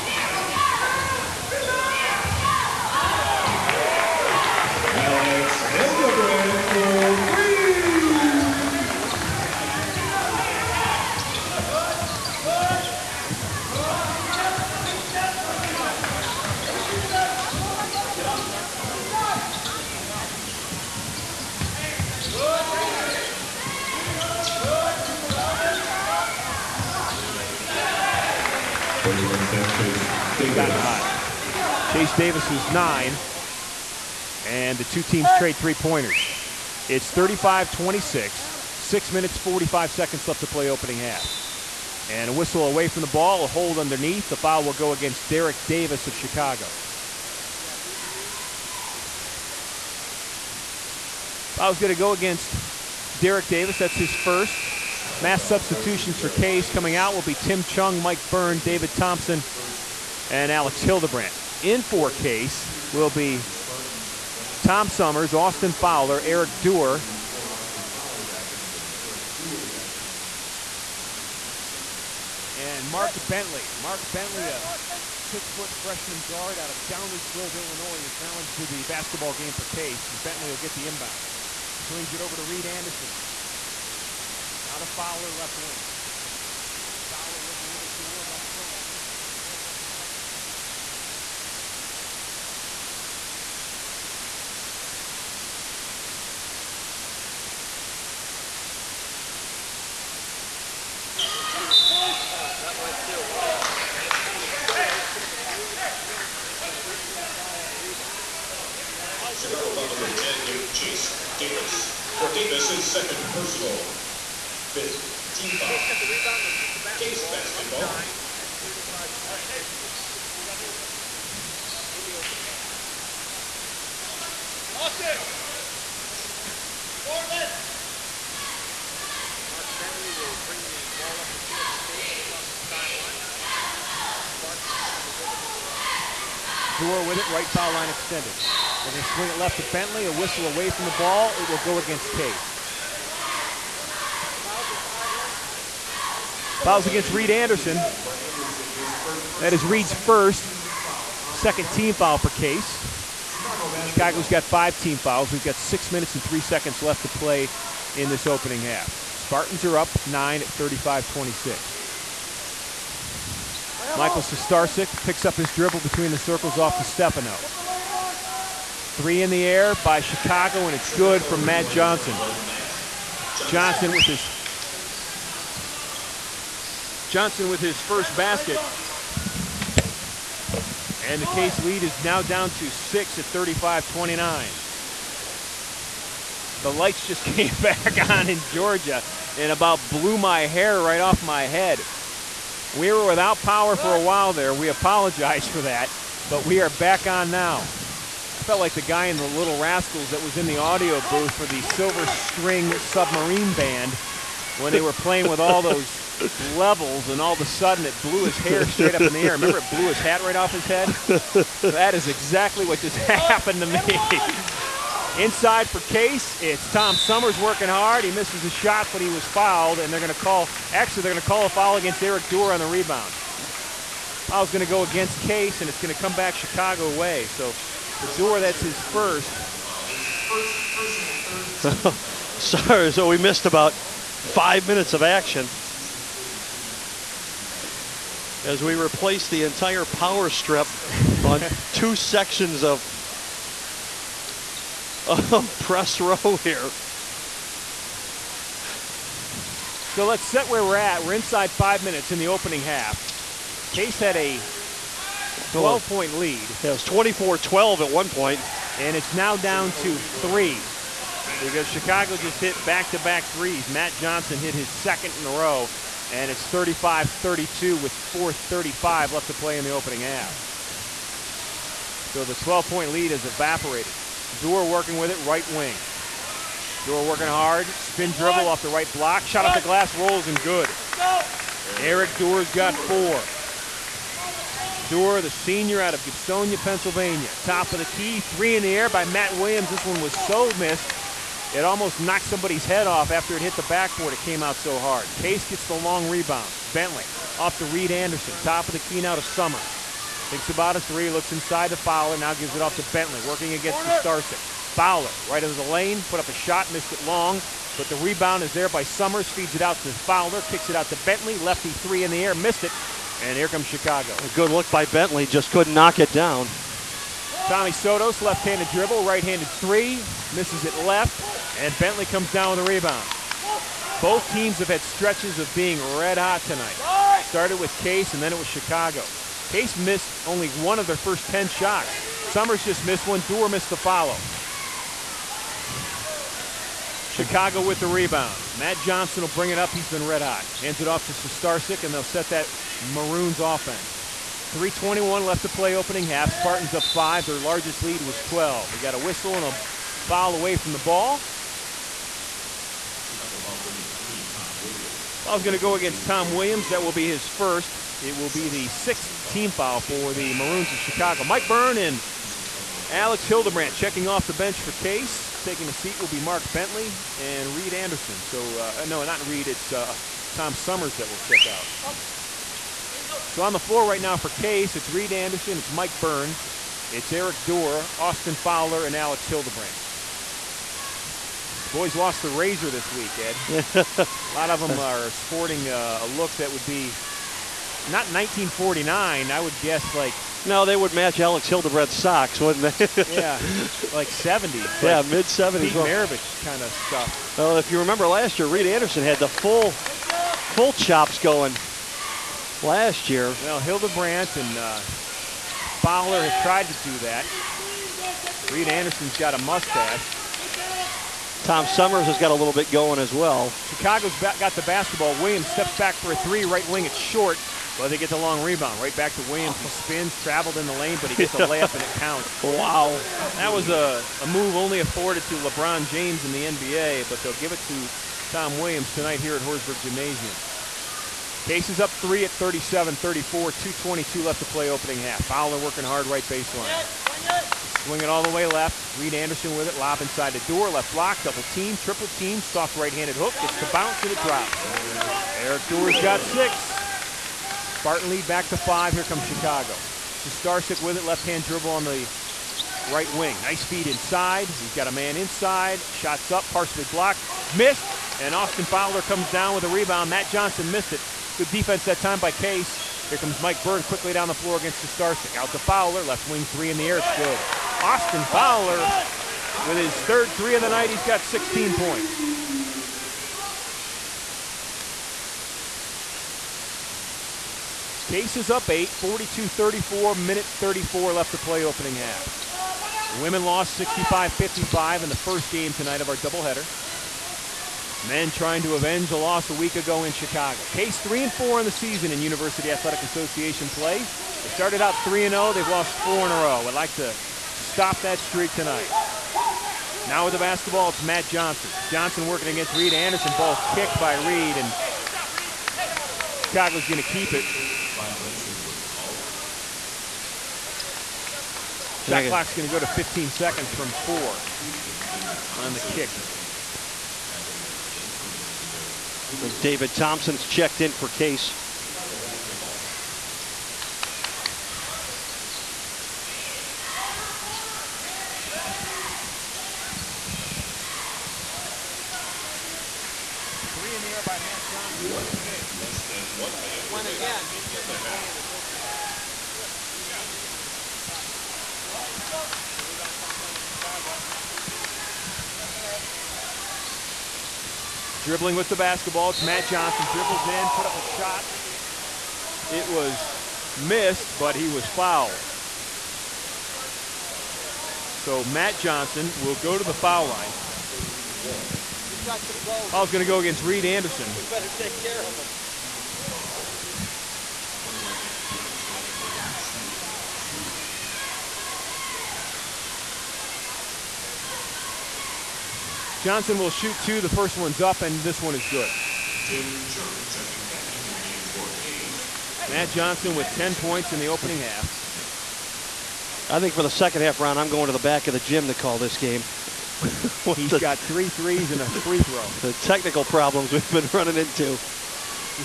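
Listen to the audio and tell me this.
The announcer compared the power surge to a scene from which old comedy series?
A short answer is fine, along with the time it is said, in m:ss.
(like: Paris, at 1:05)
The Little Rascals, at 3:19.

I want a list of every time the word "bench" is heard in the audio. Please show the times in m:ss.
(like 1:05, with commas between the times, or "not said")
6:04.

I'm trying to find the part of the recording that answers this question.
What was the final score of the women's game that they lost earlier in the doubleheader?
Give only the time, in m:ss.
8:03.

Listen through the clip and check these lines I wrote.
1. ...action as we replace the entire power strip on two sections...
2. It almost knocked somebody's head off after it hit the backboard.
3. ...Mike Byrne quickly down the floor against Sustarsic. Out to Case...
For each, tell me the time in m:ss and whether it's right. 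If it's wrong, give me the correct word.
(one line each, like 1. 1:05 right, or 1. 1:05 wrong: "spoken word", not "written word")
1. 3:55 right
2. 4:51 right
3. 7:43 wrong: "Fowler", not "Case".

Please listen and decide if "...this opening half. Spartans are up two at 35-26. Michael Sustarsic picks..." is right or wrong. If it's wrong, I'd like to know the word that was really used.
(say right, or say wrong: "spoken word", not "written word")
wrong: "nine", not "two".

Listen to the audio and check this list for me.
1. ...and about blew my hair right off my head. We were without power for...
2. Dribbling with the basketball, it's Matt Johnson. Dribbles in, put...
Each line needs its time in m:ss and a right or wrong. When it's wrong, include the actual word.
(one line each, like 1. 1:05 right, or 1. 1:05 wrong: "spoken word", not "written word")
1. 3:09 right
2. 9:08 right.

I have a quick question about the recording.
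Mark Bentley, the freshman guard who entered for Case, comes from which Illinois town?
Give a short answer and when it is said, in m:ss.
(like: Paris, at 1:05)
Downers Grove, at 1:16.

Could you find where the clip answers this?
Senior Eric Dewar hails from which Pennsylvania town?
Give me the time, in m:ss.
4:46.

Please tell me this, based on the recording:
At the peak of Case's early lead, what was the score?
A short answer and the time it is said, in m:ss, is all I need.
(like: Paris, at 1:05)
24-12, at 4:16.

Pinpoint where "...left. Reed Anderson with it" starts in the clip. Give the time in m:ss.
7:18.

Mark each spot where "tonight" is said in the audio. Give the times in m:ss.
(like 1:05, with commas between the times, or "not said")
5:26, 7:08, 8:05, 8:18.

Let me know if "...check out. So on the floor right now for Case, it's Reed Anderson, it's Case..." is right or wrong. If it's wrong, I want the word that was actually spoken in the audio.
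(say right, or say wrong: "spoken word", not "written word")
wrong: "Mike", not "Case".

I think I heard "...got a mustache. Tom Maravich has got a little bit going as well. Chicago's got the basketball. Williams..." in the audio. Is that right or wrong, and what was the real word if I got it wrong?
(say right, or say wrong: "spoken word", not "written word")
wrong: "Summers", not "Maravich".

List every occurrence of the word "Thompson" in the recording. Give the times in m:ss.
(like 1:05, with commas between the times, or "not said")
0:58, 8:39.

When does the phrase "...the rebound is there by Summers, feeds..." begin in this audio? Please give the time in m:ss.
5:07.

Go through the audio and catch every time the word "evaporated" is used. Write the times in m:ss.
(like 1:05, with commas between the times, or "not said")
4:33.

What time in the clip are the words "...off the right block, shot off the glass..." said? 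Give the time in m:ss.
4:38.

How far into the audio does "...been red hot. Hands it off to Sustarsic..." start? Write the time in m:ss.
5:39.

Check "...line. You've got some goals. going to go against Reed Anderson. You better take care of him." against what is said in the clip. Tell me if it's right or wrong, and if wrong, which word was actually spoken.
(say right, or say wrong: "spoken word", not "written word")
right.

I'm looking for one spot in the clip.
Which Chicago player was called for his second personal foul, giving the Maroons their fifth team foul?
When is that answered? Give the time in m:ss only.
1:50.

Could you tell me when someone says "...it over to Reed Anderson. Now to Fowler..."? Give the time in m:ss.
1:22.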